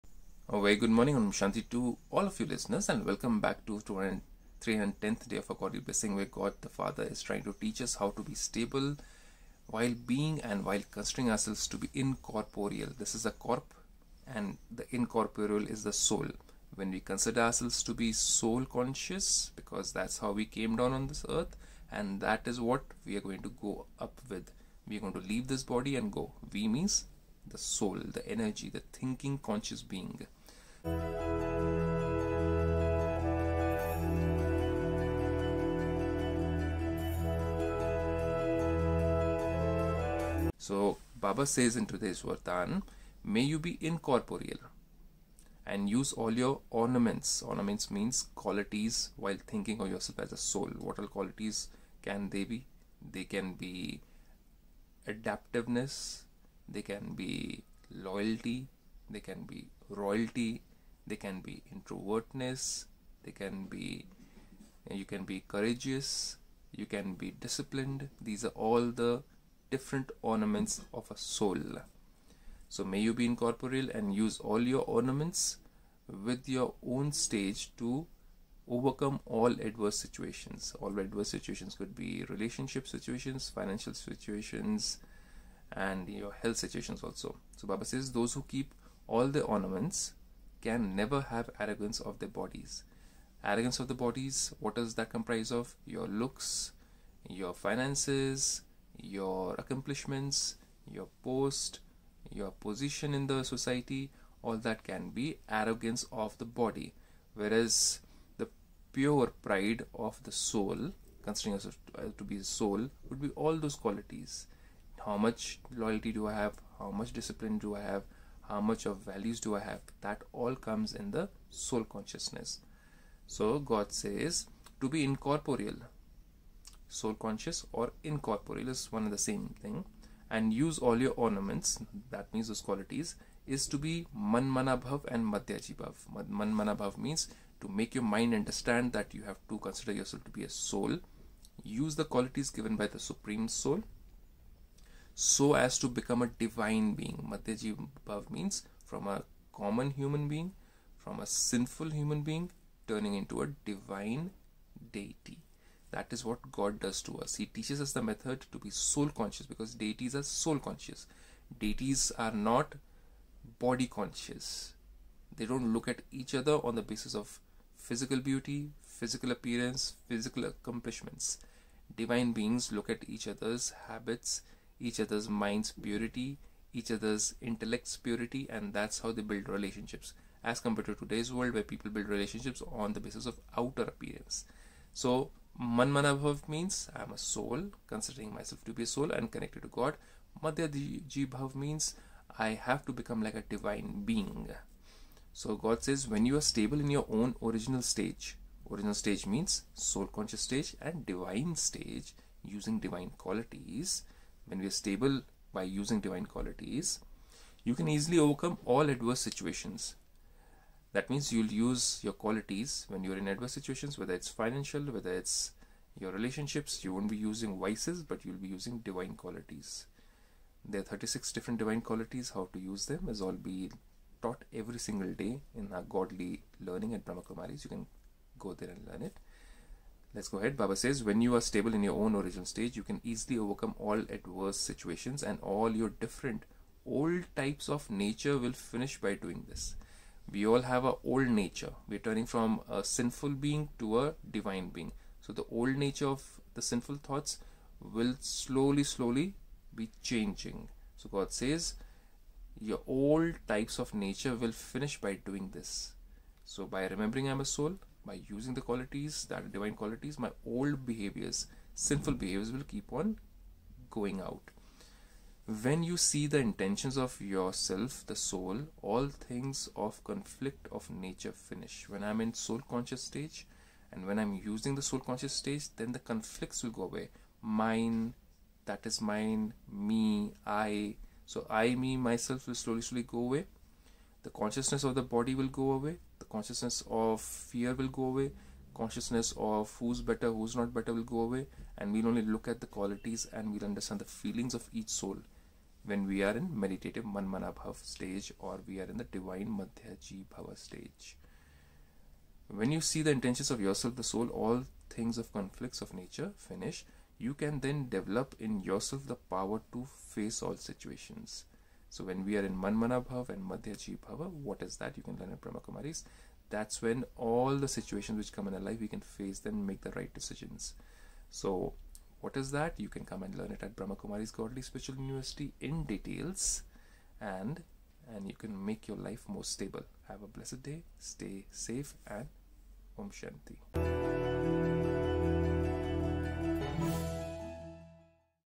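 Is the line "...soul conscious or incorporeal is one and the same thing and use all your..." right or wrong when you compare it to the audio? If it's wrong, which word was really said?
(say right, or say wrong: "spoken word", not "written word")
right.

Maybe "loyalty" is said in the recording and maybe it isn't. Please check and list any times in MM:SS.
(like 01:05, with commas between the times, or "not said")
00:57, 01:55.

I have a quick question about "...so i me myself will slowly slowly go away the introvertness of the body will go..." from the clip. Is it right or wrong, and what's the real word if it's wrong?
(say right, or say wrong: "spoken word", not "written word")
wrong: "consciousness", not "introvertness".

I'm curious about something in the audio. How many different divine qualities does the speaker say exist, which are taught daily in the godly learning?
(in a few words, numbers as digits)
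36.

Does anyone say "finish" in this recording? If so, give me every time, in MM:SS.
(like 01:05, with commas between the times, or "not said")
03:58, 04:14, 04:31, 05:06.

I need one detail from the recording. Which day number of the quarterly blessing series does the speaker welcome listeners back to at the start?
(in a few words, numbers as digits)
310th.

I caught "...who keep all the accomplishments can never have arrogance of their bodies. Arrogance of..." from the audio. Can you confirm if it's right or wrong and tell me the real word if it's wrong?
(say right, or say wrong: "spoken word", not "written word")
wrong: "ornaments", not "accomplishments".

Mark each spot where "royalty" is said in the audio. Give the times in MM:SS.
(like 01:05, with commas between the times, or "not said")
00:59.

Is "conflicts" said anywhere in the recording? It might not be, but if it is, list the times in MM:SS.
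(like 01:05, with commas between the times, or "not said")
04:30, 04:35, 05:05.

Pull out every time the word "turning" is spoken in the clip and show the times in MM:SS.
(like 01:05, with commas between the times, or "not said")
02:32, 04:01.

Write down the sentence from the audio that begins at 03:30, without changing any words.
That means you'll use your qualities when you're in adverse situations, whether it's financial, whether it's your relationships.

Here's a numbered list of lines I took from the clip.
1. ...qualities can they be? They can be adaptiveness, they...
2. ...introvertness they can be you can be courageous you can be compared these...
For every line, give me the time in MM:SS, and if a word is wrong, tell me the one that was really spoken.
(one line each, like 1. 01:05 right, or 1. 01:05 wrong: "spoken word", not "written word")
1. 00:51 right
2. 01:01 wrong: "disciplined", not "compared".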